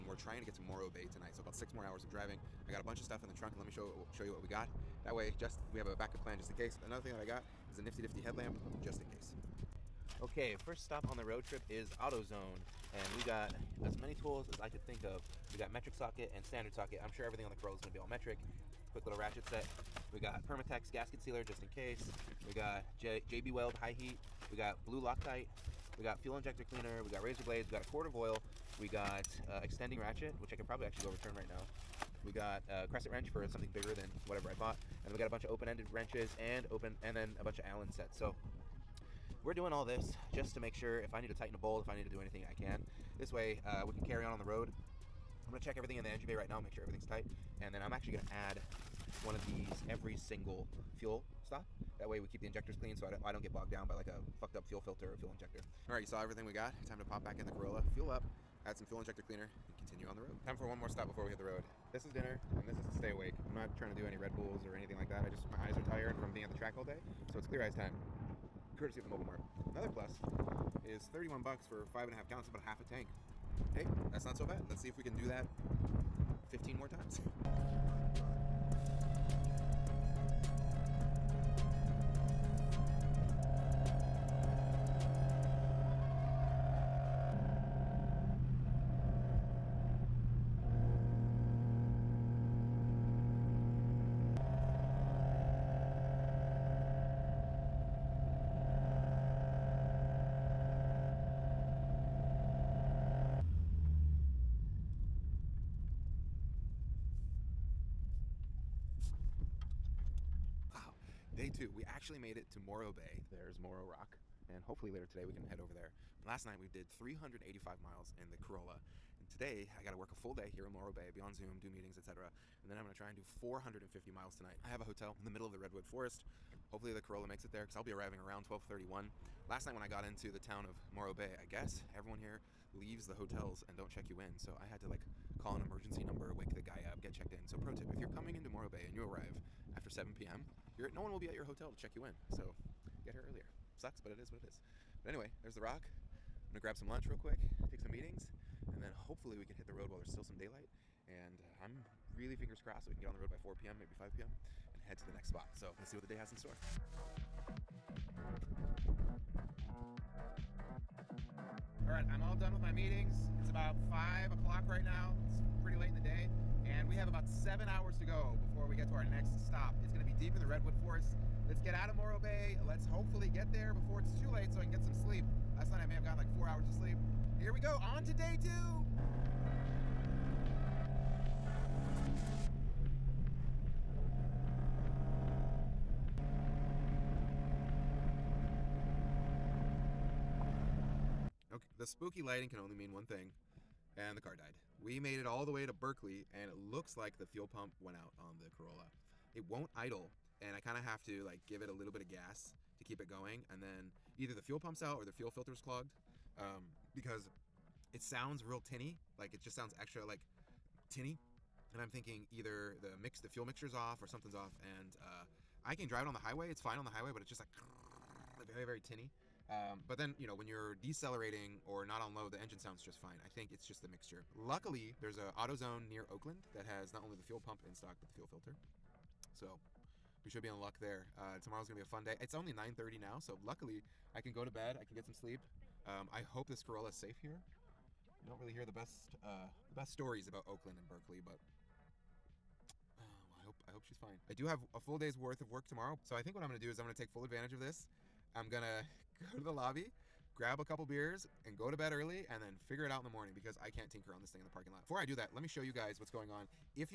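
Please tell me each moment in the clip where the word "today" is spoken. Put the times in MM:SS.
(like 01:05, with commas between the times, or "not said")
01:55, 01:59.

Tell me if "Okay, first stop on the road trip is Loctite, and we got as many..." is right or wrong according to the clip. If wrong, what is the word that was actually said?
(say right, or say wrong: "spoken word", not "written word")
wrong: "AutoZone", not "Loctite".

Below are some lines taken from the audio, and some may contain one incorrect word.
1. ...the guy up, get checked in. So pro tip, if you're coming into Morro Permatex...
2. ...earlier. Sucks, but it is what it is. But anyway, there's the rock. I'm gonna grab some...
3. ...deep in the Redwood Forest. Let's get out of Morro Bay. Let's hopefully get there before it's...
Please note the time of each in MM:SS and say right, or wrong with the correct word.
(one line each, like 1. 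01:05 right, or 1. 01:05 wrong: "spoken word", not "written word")
1. 02:16 wrong: "Bay", not "Permatex"
2. 02:23 right
3. 02:50 right.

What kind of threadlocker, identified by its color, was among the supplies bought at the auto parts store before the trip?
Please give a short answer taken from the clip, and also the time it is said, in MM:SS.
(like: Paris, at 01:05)
Blue Loctite, at 00:24.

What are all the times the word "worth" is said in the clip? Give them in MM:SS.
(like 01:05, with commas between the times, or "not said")
04:05.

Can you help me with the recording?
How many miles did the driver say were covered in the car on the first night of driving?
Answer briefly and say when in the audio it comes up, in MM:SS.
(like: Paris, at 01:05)
385, at 01:56.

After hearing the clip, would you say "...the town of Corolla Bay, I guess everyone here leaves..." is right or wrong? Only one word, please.
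wrong.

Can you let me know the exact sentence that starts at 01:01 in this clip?
This is dinner, and this is to stay awake.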